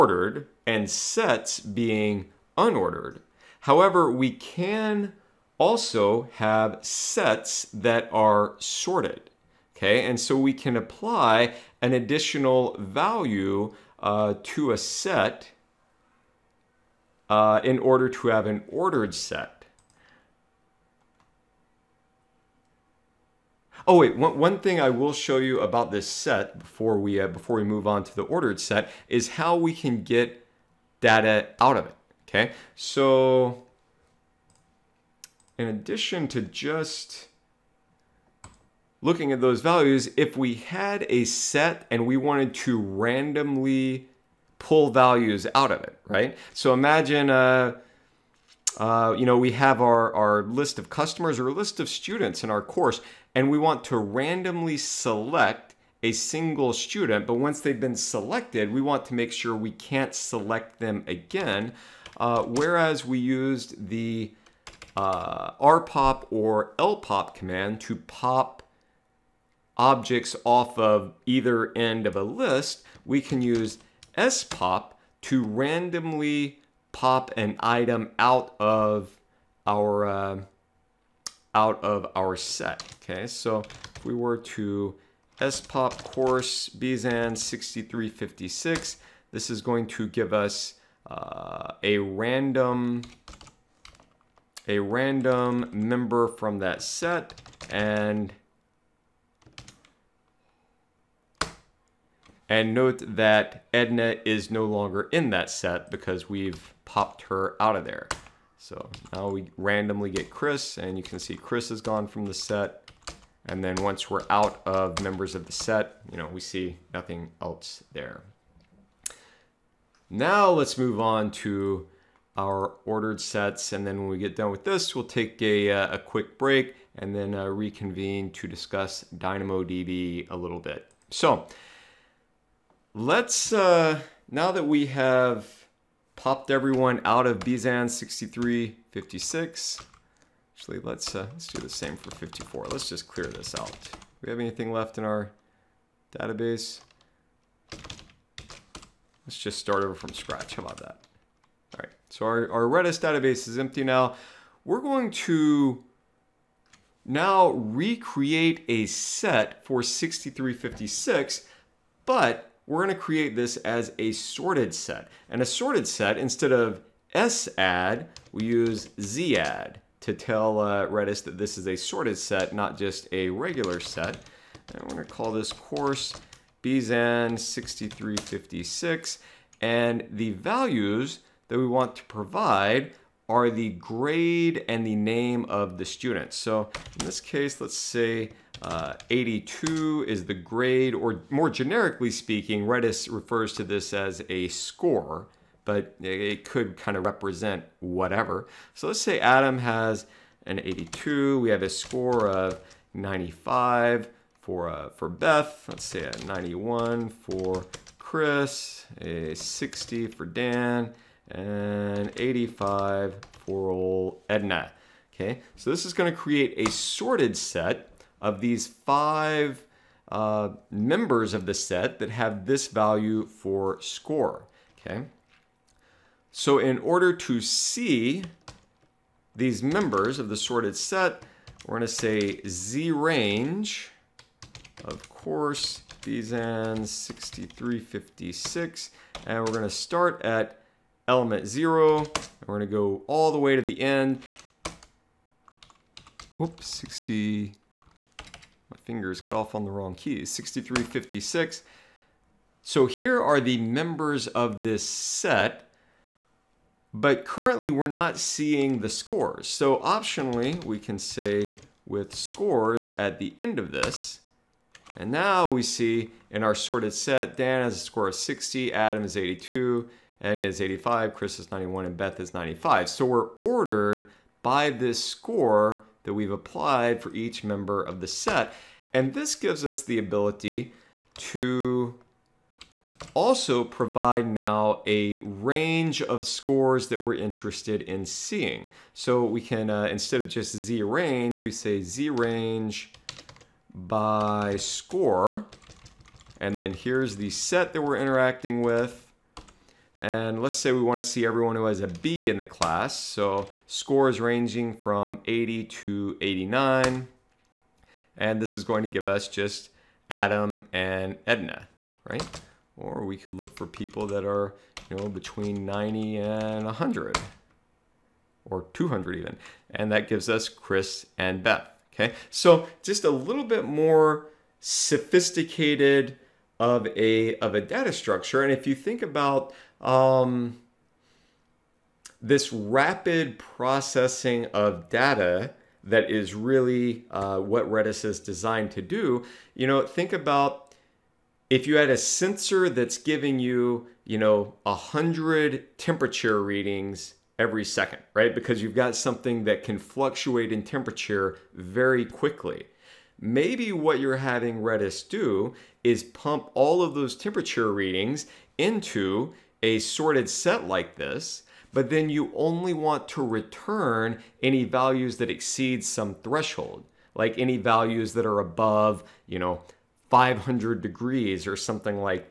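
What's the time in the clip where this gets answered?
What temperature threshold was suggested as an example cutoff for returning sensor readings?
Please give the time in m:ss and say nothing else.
6:10.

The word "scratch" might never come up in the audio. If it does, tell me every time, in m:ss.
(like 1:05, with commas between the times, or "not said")
2:30.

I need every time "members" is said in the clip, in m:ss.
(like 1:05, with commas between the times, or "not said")
1:35, 1:55, 3:40, 3:49, 4:13, 4:37.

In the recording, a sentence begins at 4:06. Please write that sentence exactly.
Whoops, 60, fingers got off on the wrong keys.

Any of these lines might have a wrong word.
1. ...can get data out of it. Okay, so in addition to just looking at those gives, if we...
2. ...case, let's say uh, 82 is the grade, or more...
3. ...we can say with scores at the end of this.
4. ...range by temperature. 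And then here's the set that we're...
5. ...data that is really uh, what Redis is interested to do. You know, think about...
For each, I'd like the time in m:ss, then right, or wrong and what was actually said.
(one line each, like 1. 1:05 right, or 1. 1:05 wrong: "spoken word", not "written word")
1. 0:29 wrong: "values", not "gives"
2. 3:07 right
3. 4:20 right
4. 4:52 wrong: "score", not "temperature"
5. 5:34 wrong: "designed", not "interested".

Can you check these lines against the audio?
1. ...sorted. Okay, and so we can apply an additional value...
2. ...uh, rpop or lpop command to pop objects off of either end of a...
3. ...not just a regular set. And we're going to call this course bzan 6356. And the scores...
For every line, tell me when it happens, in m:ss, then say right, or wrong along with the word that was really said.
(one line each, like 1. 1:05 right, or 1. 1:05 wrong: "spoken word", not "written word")
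1. 0:08 right
2. 1:04 right
3. 2:52 wrong: "values", not "scores".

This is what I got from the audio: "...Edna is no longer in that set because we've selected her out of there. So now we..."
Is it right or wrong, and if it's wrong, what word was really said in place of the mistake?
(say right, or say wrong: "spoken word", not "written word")
wrong: "popped", not "selected".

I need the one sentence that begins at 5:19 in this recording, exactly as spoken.
And that gives us Chris and Beth, okay?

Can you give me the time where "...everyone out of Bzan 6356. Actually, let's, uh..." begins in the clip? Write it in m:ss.
2:16.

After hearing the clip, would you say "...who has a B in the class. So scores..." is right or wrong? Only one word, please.
right.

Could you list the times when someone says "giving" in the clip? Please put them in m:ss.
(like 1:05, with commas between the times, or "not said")
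5:42.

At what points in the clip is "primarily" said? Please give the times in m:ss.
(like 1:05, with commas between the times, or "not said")
not said.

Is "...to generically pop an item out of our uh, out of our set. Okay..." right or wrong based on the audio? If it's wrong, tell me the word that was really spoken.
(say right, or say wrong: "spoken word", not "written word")
wrong: "randomly", not "generically".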